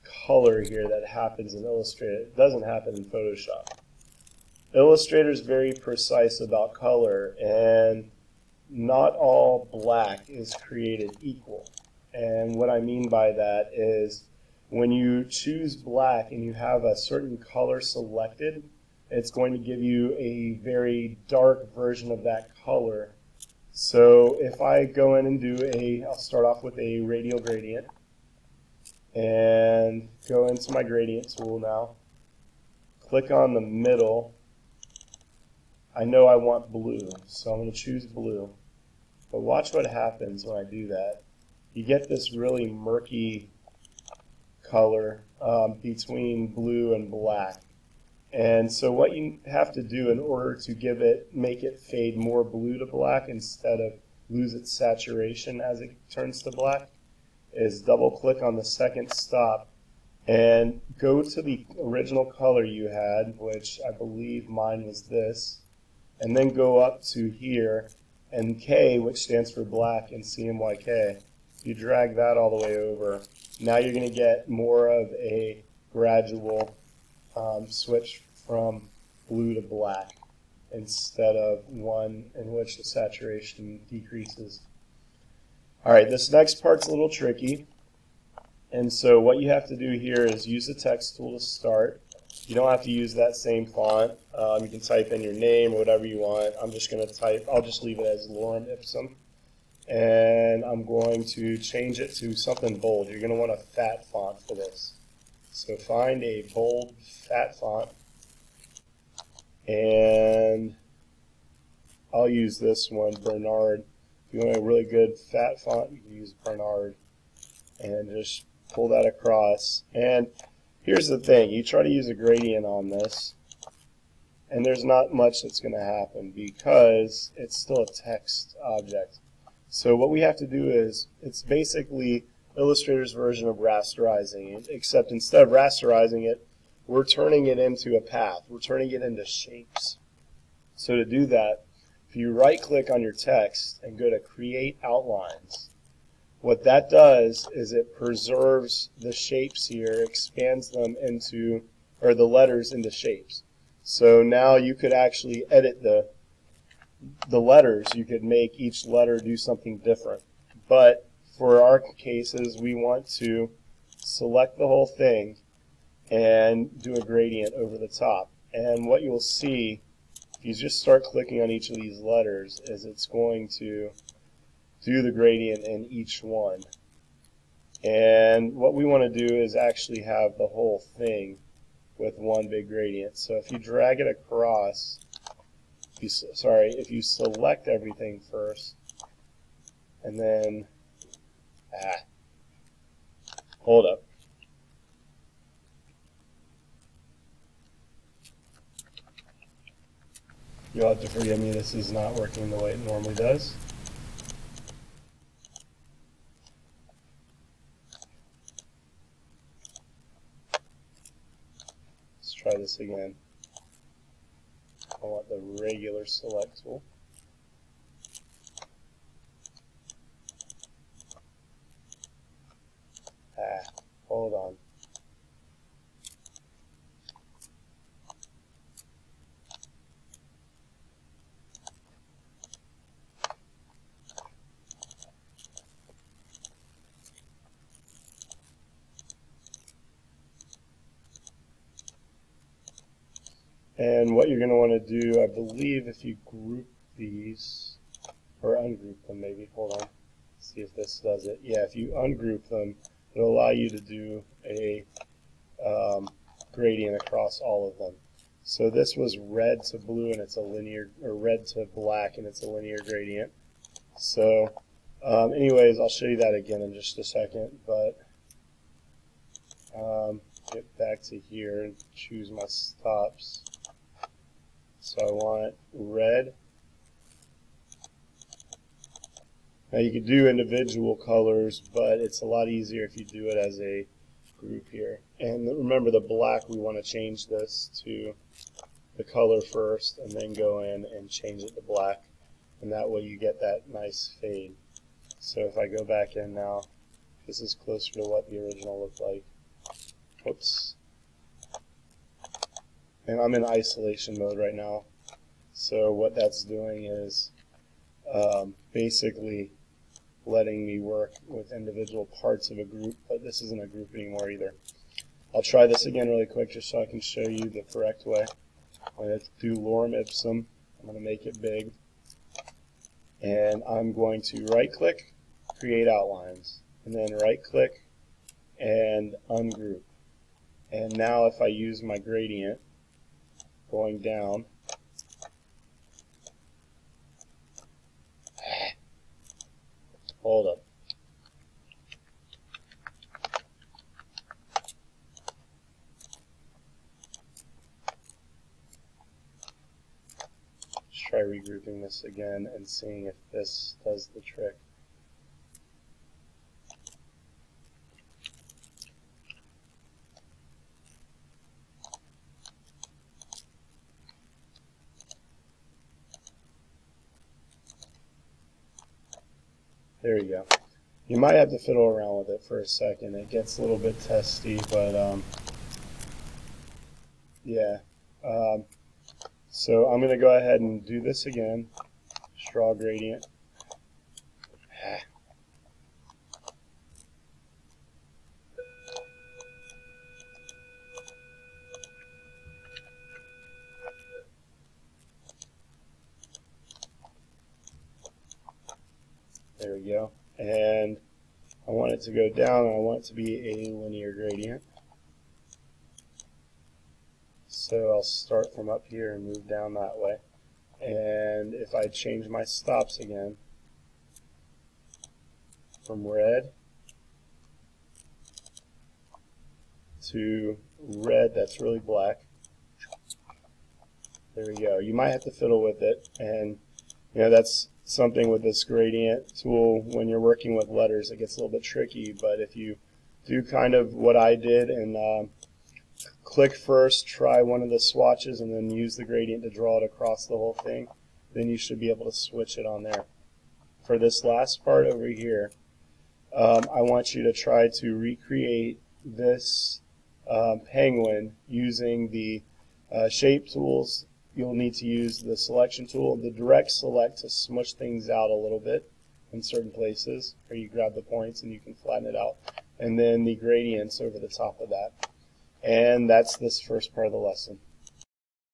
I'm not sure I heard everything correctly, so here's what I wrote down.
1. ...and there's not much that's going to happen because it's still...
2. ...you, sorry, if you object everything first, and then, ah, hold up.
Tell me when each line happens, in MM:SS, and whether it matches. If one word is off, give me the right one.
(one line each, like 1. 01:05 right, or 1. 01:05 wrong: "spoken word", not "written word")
1. 02:04 right
2. 03:06 wrong: "select", not "object".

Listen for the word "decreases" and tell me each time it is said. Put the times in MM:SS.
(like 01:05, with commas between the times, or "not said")
01:23.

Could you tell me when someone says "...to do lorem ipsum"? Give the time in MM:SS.
05:19.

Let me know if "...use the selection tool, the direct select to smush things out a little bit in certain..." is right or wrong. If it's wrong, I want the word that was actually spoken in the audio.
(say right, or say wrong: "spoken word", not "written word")
right.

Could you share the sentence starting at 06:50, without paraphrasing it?
And if I change my stops again from red to red that's really black.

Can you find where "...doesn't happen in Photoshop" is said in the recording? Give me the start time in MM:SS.
00:02.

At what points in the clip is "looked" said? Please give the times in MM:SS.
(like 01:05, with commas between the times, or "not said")
04:58.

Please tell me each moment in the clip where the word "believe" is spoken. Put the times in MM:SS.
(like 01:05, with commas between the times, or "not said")
01:03, 04:05.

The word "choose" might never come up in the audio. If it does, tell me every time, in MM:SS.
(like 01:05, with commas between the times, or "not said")
00:15, 00:37, 04:31.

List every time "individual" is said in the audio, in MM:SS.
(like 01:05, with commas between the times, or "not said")
04:40, 05:11.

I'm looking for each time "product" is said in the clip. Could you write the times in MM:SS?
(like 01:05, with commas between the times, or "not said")
not said.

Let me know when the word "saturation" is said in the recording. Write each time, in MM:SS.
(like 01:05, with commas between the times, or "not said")
00:54, 01:22.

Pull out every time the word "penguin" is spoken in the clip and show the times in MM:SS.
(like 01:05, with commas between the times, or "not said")
07:30.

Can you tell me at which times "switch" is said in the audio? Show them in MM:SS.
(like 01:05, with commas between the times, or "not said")
01:17, 07:22.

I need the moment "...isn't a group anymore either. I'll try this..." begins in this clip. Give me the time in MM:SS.
05:13.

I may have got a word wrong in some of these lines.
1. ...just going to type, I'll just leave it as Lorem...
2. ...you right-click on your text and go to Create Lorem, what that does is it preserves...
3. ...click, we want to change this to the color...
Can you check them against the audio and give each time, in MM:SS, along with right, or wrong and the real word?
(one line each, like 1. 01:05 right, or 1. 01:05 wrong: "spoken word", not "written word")
1. 01:36 right
2. 02:22 wrong: "Outlines", not "Lorem"
3. 04:45 wrong: "black", not "click".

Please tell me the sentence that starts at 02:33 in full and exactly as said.
So now you could actually edit the, the letters.